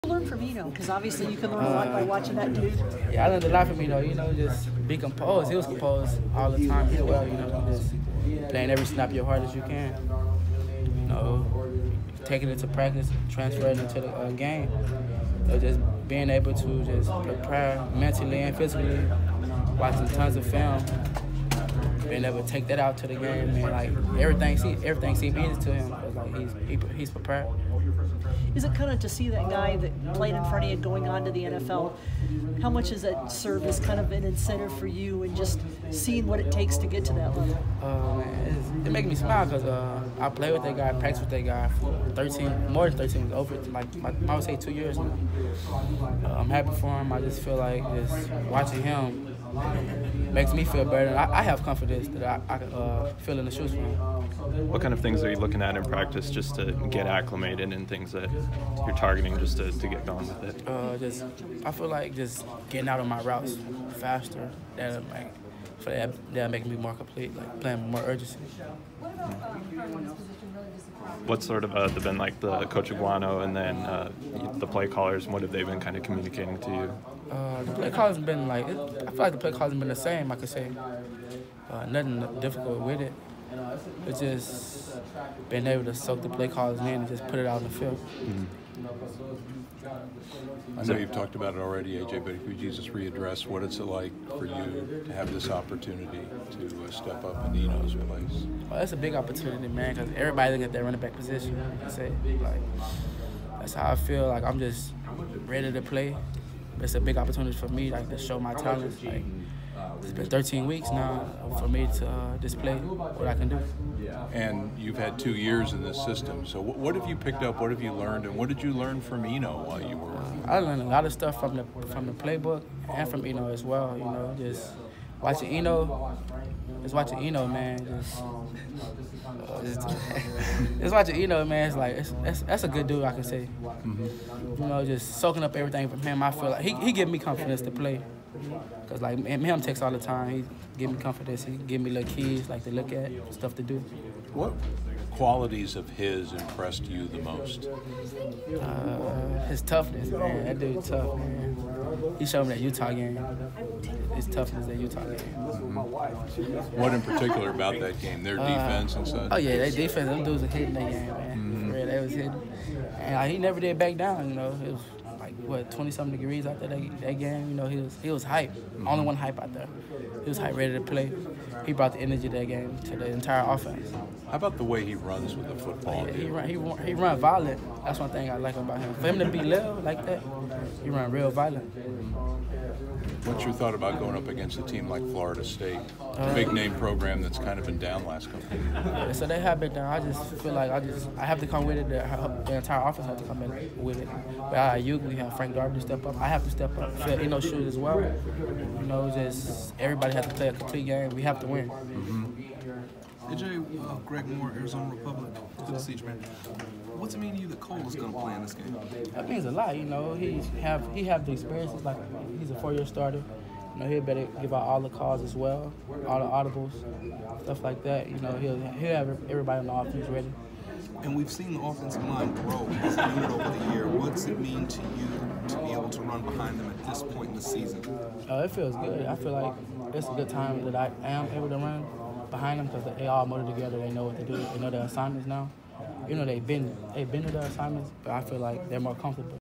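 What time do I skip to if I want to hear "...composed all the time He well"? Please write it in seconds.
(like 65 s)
5 s.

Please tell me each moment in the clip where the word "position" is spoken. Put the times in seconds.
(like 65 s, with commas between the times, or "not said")
101 s.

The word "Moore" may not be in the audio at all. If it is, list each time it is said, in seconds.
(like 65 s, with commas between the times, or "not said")
204 s.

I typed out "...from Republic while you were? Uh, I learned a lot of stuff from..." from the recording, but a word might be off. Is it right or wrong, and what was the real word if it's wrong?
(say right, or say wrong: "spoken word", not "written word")
wrong: "Eno", not "Republic".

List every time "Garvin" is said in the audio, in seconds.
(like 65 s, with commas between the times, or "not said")
195 s.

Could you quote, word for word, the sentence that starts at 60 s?
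Uh, just I feel like just getting out of my routes faster.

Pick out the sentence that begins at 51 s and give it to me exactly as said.
I, I have confidence that I, I uh, fill in the shoes from.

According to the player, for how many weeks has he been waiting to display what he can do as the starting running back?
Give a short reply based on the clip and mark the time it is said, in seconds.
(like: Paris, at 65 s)
13, at 110 s.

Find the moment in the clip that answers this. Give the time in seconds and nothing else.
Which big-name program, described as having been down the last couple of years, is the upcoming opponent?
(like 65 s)
185 s.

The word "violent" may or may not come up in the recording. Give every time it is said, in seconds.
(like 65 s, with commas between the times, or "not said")
177 s, 181 s.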